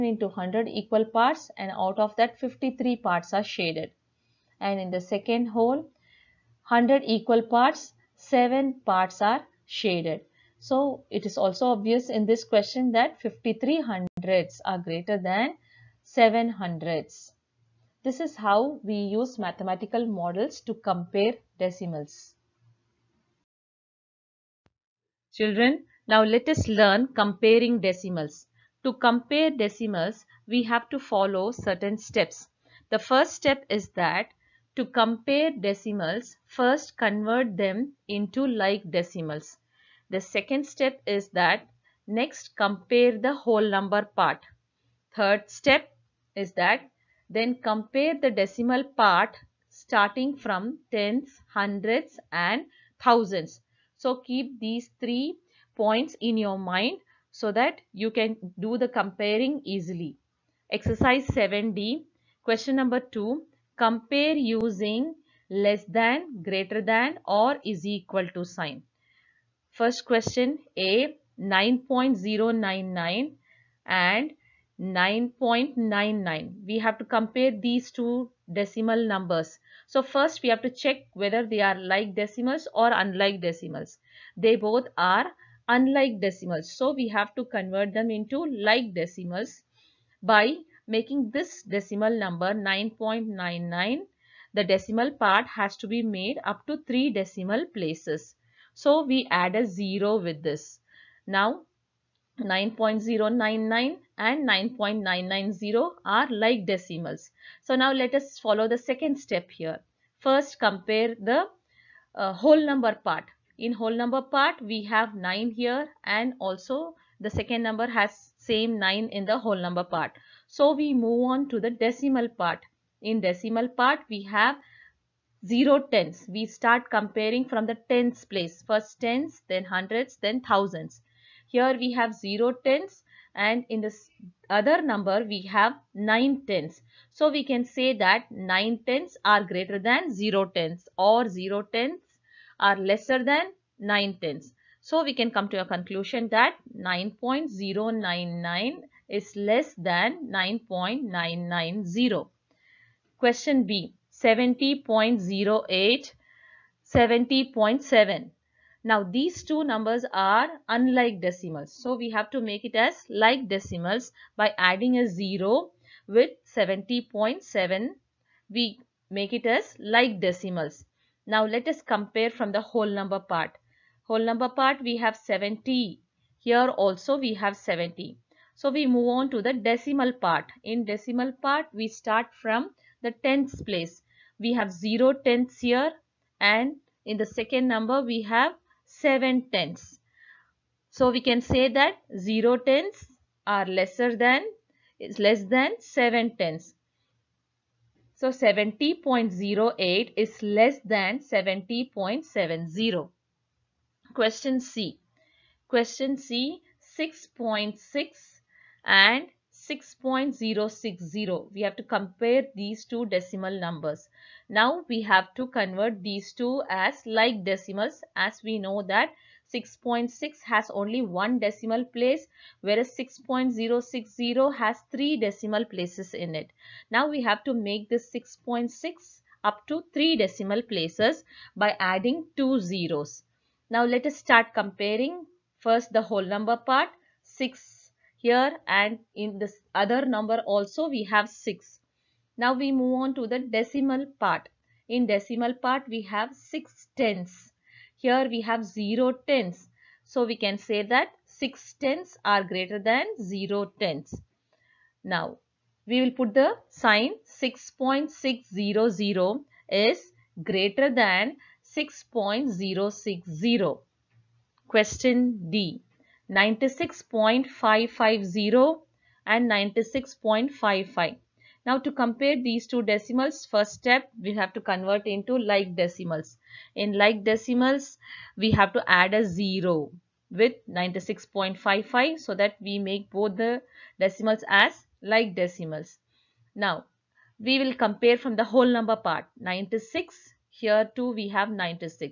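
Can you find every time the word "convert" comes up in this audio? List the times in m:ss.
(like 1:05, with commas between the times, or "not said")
0:36, 1:27, 3:35, 4:34.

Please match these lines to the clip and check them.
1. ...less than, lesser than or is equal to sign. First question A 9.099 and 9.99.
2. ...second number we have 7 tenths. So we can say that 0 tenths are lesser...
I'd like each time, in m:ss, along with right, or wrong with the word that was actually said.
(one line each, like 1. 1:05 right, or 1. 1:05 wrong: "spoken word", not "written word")
1. 1:05 wrong: "greater", not "lesser"
2. 3:07 right.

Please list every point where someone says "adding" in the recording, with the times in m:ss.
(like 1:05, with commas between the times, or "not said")
2:44, 3:51.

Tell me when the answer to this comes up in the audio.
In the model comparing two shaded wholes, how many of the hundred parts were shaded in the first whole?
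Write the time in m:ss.
0:02.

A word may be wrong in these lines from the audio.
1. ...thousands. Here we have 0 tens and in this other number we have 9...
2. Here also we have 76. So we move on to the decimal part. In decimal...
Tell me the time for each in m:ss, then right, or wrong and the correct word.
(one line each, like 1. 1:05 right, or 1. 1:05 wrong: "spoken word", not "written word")
1. 2:10 right
2. 2:56 wrong: "70", not "76".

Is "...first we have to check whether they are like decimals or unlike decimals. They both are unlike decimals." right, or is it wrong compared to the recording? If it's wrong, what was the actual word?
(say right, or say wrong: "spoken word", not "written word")
right.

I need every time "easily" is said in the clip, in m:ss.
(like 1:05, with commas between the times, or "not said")
0:59.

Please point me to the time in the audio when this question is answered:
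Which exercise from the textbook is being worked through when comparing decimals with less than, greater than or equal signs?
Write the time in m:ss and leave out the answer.
1:00.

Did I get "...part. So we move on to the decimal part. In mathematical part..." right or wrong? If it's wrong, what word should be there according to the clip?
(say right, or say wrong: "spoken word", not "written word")
wrong: "decimal", not "mathematical".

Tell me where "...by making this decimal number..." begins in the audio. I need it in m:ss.
1:30.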